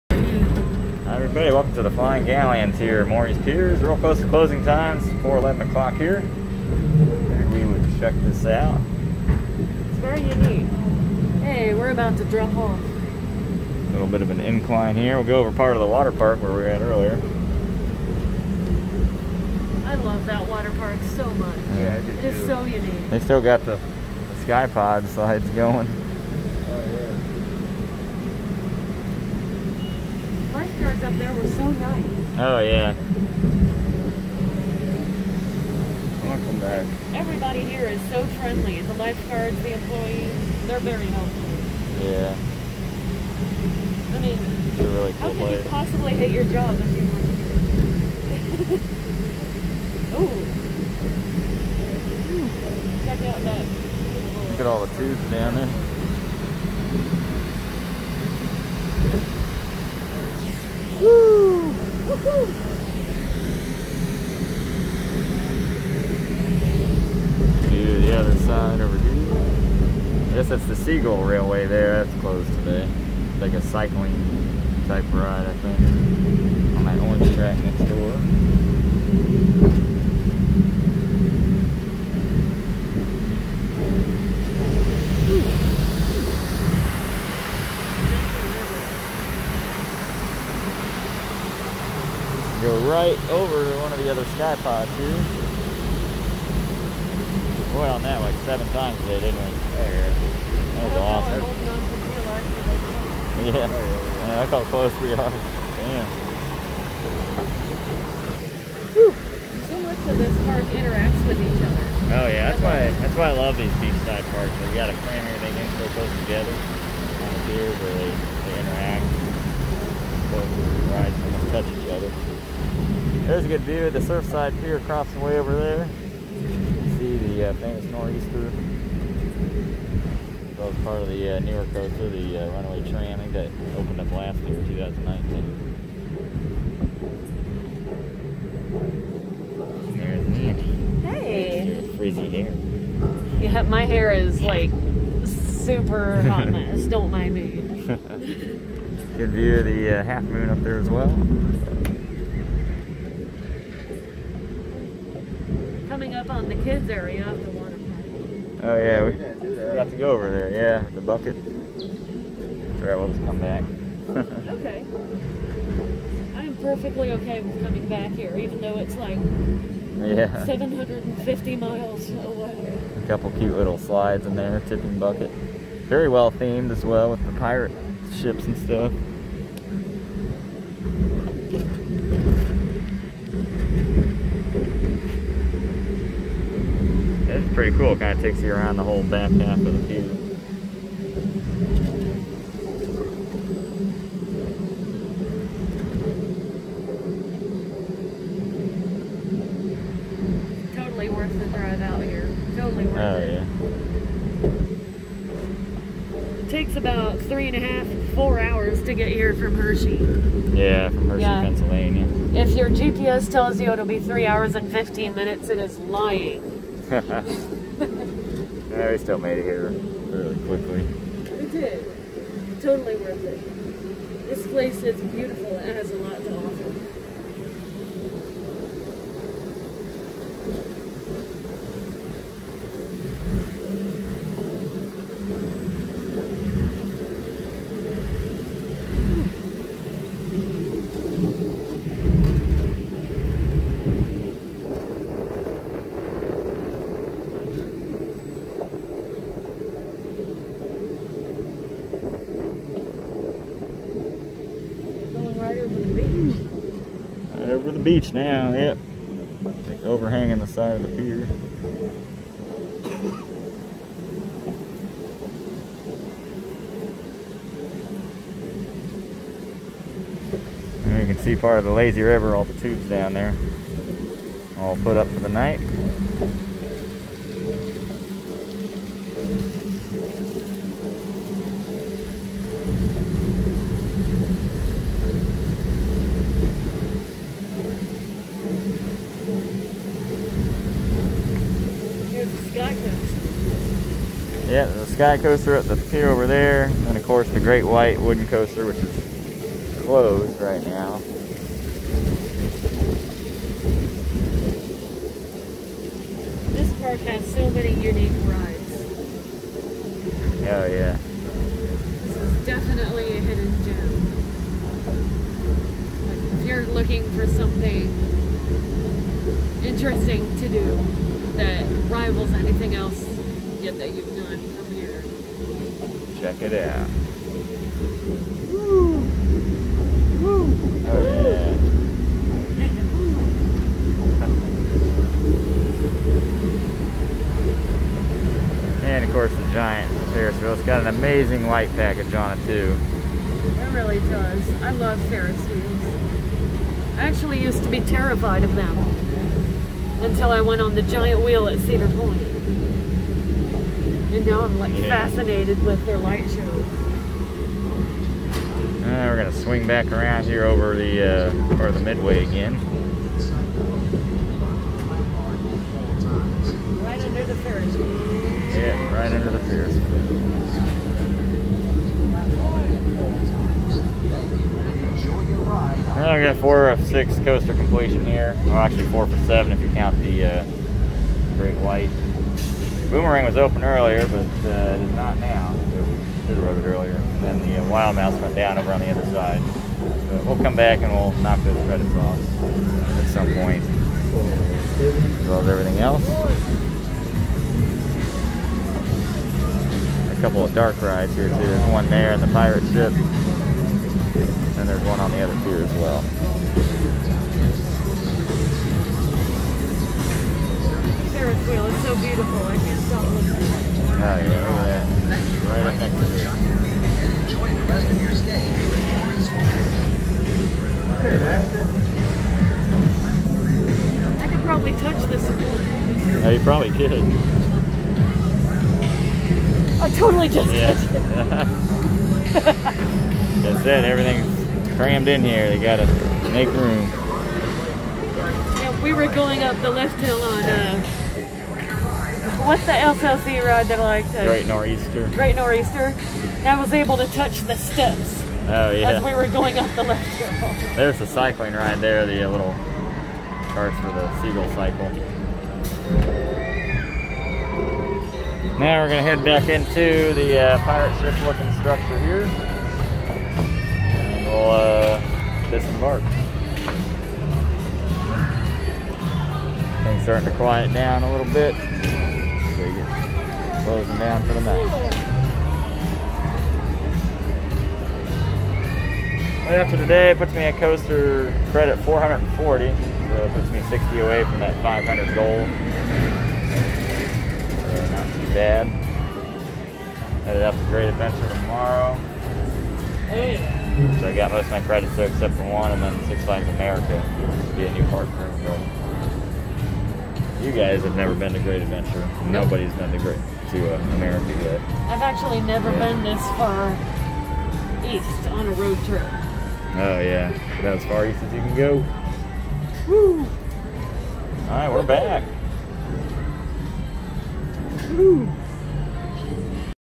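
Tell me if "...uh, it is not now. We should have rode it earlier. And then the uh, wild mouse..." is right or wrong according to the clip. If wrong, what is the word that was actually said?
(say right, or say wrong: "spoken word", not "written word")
right.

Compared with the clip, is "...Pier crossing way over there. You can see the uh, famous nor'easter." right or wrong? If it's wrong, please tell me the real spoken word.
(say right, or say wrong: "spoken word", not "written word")
right.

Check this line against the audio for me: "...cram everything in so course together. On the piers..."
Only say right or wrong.
wrong.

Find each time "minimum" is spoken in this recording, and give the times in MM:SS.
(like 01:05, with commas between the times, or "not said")
not said.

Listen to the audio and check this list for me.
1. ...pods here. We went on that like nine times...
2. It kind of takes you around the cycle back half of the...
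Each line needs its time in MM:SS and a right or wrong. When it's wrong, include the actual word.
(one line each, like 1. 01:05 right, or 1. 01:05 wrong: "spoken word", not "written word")
1. 01:34 wrong: "seven", not "nine"
2. 03:07 wrong: "whole", not "cycle".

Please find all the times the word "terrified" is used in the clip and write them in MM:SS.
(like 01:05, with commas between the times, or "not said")
05:47.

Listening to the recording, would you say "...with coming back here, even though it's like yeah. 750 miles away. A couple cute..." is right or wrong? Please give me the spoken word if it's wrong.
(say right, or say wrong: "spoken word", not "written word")
right.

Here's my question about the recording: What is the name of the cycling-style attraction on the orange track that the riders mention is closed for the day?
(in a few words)
Seagull Railway.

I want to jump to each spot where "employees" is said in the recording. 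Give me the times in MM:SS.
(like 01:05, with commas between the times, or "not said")
00:39.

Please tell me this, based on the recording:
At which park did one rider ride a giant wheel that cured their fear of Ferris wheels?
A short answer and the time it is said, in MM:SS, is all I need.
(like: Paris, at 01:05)
Cedar Point, at 05:51.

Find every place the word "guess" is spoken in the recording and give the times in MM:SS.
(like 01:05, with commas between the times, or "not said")
01:10.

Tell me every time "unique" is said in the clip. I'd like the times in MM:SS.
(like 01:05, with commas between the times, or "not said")
00:10, 00:22, 05:07.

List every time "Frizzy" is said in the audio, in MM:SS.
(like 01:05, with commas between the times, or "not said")
02:21.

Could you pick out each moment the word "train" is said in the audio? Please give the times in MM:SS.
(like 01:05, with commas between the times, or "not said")
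02:12.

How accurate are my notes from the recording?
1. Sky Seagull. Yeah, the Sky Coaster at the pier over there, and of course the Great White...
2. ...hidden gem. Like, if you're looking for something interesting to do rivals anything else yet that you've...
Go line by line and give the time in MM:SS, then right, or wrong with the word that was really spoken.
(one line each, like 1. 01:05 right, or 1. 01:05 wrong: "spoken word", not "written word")
1. 04:52 wrong: "Coaster", not "Seagull"
2. 05:13 right.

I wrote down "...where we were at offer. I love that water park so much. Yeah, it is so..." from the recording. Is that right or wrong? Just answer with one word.
wrong.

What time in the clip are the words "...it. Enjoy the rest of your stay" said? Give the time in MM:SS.
06:56.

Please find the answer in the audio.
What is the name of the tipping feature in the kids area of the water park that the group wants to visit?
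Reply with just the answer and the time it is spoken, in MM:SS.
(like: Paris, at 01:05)
the bucket, at 02:40.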